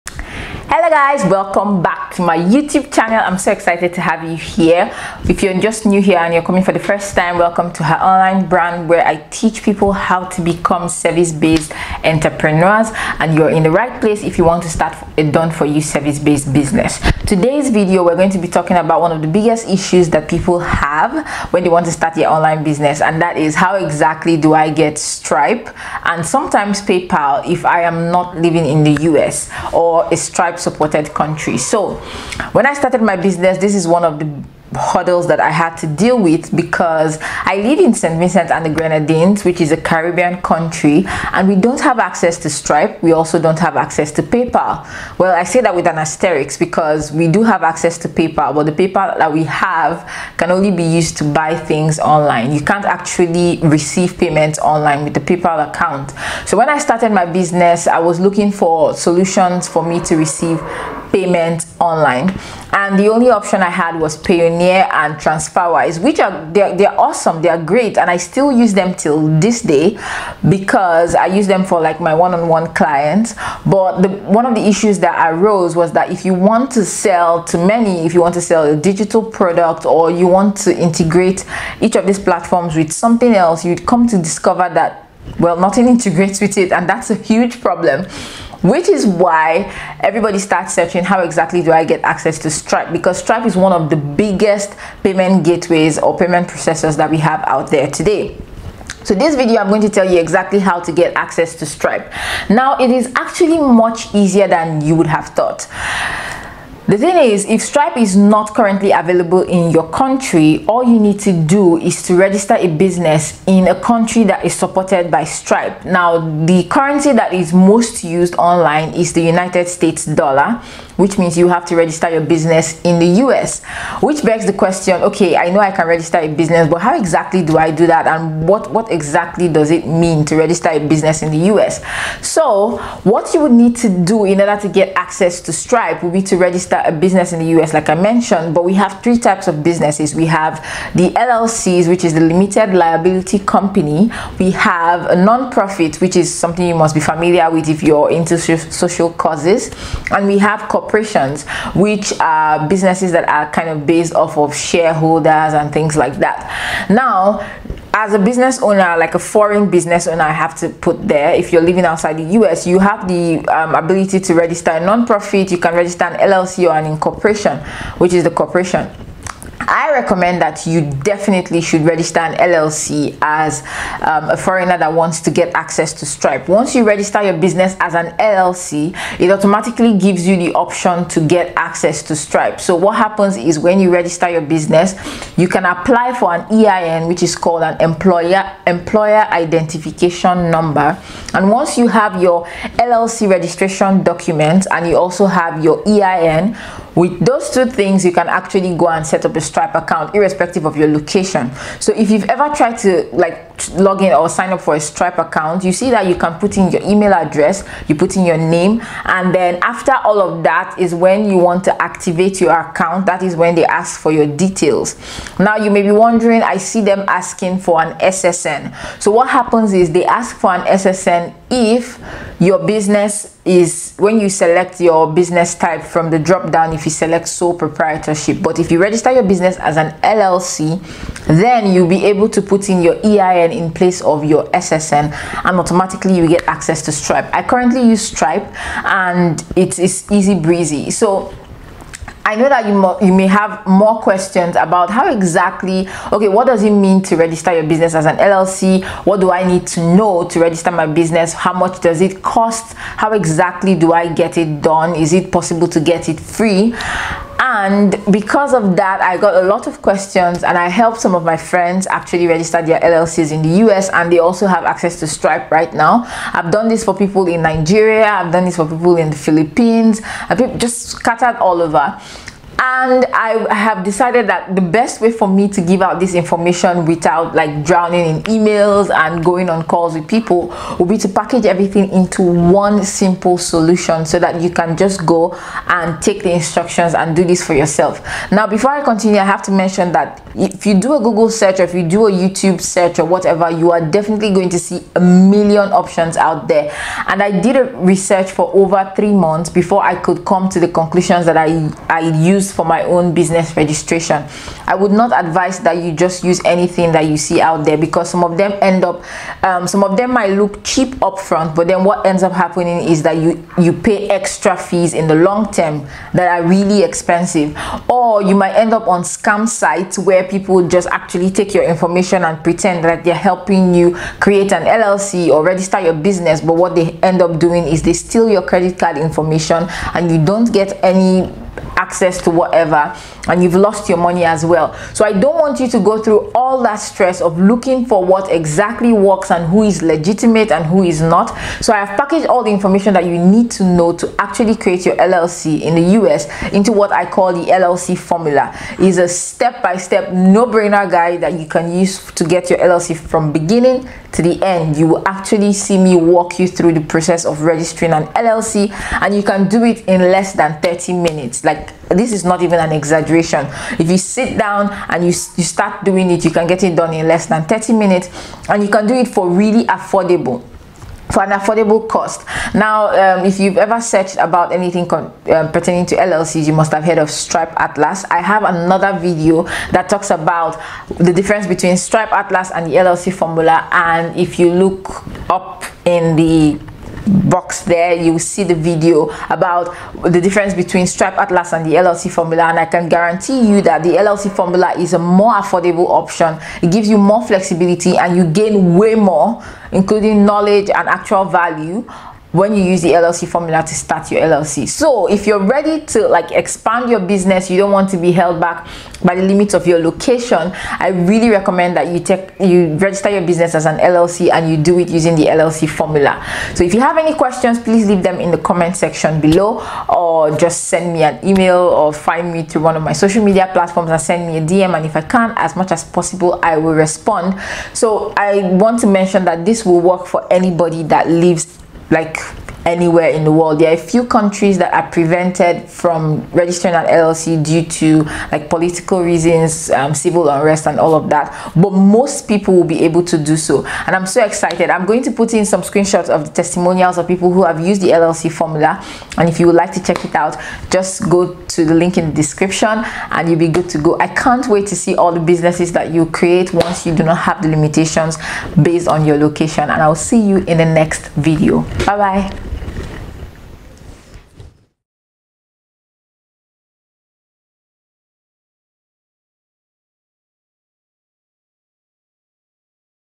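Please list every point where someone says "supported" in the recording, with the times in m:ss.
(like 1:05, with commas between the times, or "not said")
0:30, 1:54.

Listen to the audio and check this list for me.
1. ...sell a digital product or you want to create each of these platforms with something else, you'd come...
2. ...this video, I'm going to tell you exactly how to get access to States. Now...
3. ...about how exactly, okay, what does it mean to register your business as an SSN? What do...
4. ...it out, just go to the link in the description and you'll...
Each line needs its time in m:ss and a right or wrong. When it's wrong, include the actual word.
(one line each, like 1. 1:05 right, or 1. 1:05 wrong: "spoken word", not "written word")
1. 1:18 wrong: "integrate", not "create"
2. 1:39 wrong: "Stripe", not "States"
3. 4:04 wrong: "LLC", not "SSN"
4. 7:30 right.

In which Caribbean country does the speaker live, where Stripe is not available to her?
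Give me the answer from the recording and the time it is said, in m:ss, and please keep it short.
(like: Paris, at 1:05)
St. Vincent and the Grenadines, at 0:37.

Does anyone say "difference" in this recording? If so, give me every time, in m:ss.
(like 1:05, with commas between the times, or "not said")
6:21, 6:30.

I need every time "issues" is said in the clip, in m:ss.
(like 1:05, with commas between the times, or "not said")
0:19, 1:14.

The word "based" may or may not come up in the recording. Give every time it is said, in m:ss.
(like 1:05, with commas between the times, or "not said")
0:10, 0:15, 2:33, 7:38.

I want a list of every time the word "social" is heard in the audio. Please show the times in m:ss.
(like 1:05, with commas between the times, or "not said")
2:28, 7:02.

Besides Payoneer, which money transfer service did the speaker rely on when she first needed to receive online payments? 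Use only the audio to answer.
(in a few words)
TransferWise.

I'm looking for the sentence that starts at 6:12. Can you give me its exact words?
Now, um, if you've ever searched about anything um, pertaining to LLCs, you must have heard of Stripe Atlas.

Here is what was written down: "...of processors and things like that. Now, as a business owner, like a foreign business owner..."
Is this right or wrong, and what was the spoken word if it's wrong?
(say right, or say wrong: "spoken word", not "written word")
wrong: "shareholders", not "processors".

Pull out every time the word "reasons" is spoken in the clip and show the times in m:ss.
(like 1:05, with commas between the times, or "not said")
7:19.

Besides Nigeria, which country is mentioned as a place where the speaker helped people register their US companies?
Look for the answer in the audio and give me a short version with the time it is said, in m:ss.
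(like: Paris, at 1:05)
The Philippines, at 4:29.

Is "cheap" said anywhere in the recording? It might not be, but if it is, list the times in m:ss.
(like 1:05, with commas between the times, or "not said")
5:10.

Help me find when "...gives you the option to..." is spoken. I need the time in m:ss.
2:59.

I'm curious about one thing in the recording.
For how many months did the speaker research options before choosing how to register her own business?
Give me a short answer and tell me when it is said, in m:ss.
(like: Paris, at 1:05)
3, at 4:58.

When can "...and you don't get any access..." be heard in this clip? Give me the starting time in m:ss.
5:29.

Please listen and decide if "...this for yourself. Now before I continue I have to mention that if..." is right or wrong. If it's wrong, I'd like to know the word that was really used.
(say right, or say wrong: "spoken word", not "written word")
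right.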